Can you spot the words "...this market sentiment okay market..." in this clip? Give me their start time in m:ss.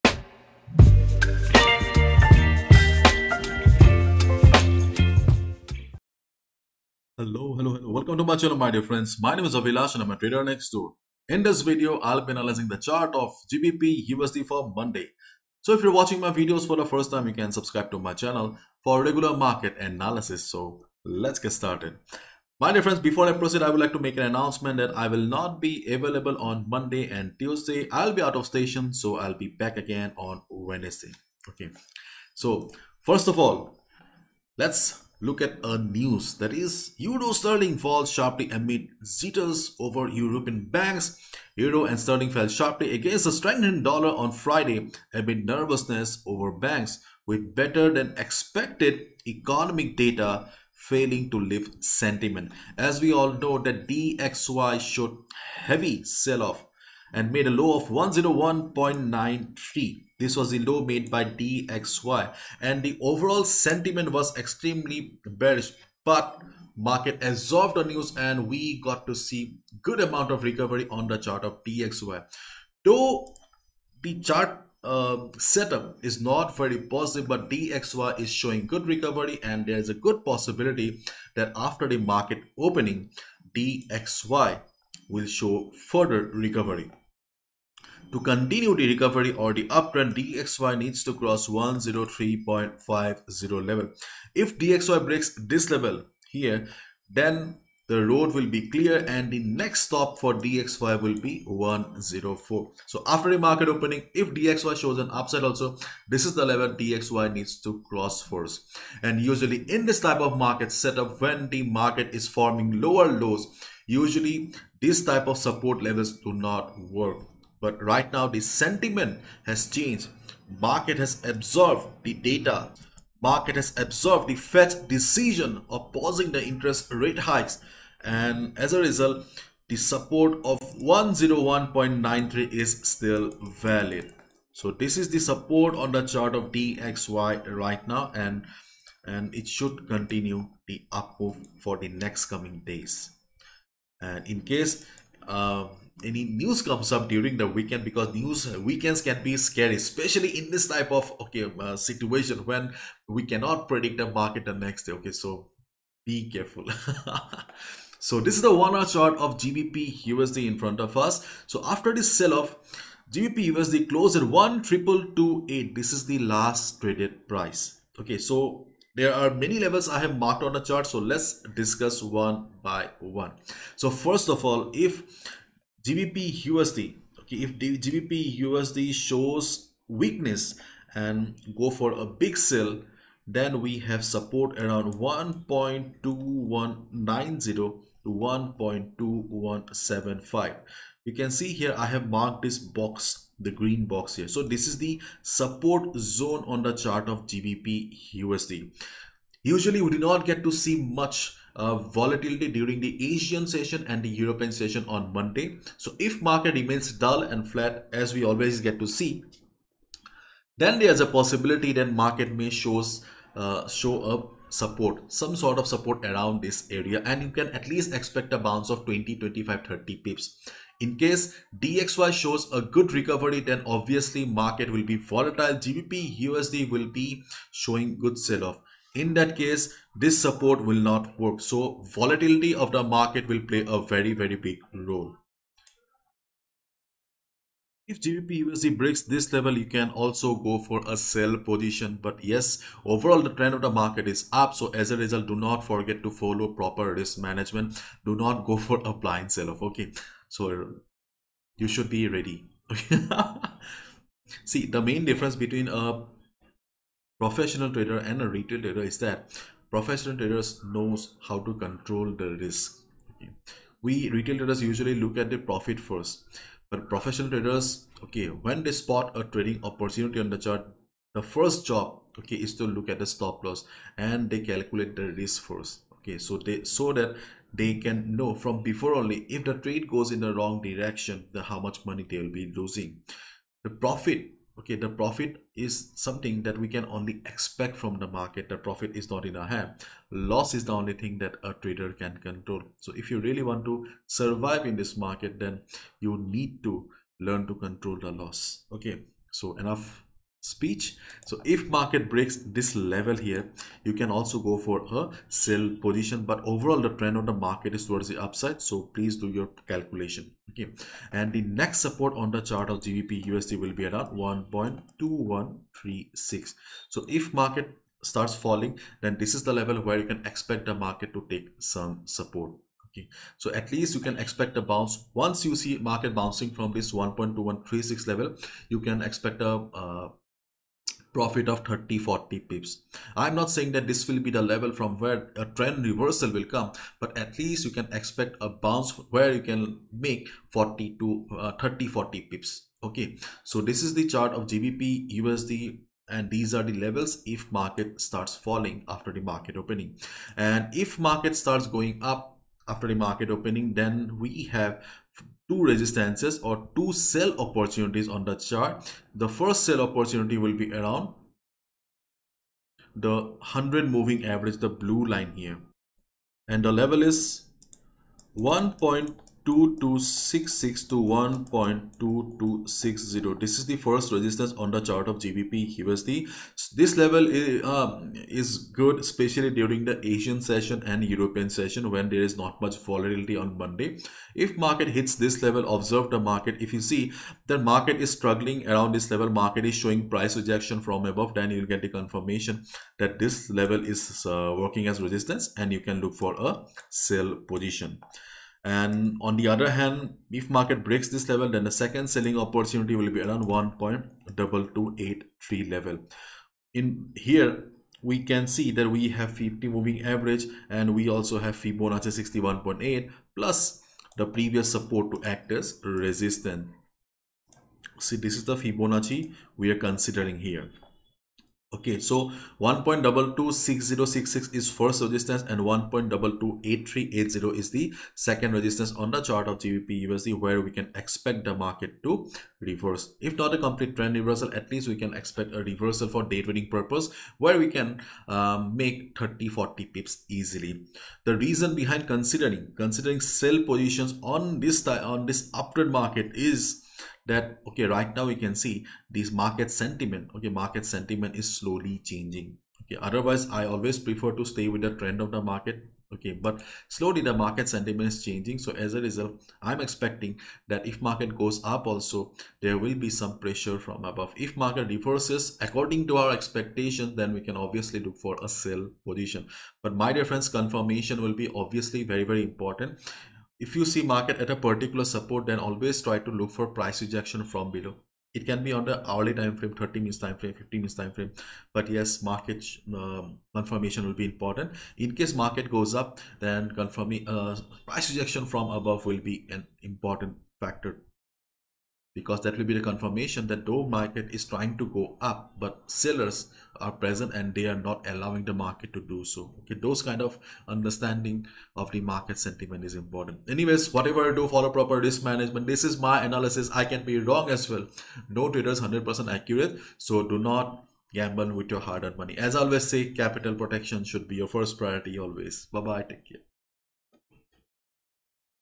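7:29.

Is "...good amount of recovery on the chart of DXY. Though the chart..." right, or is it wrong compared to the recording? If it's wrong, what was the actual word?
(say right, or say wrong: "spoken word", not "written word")
right.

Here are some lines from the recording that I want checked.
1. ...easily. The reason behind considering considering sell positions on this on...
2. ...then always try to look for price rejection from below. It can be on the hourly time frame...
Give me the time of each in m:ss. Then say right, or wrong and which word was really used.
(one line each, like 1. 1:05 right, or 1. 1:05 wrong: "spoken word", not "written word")
1. 7:20 right
2. 7:55 right.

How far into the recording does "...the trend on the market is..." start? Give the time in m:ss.
5:06.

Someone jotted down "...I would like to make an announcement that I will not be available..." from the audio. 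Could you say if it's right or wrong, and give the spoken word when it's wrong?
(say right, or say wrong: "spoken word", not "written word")
right.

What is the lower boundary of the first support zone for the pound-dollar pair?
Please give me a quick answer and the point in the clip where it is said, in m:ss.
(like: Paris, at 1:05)
1.2175, at 3:08.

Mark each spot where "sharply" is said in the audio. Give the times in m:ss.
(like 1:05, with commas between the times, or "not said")
0:38, 0:42.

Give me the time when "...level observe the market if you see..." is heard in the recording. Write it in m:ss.
6:25.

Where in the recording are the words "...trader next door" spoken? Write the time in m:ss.
0:10.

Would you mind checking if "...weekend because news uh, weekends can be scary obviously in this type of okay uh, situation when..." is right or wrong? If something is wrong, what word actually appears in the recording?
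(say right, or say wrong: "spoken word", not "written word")
wrong: "especially", not "obviously".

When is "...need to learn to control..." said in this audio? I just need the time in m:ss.
4:56.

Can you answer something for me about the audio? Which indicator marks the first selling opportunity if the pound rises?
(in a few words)
100 moving average.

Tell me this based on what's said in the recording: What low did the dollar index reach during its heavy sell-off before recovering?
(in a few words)
101.93.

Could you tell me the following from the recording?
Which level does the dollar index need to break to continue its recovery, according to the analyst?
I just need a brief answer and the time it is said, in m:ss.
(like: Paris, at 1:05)
103.50, at 1:31.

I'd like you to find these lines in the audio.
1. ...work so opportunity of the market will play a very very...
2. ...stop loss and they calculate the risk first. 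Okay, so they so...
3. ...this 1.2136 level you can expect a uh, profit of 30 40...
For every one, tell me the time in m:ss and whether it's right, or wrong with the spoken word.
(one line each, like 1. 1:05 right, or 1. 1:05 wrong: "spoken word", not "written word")
1. 3:51 wrong: "volatility", not "opportunity"
2. 4:33 right
3. 5:26 right.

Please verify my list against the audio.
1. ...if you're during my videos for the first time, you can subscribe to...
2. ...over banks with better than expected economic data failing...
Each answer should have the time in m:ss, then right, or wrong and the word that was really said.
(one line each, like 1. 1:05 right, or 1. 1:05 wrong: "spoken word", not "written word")
1. 0:15 wrong: "watching", not "during"
2. 0:46 right.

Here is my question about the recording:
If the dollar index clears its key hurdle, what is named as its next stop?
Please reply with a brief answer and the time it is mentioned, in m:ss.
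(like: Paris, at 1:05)
104, at 1:41.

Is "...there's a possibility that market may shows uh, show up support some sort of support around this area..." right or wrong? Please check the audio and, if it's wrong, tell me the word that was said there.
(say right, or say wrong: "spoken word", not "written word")
right.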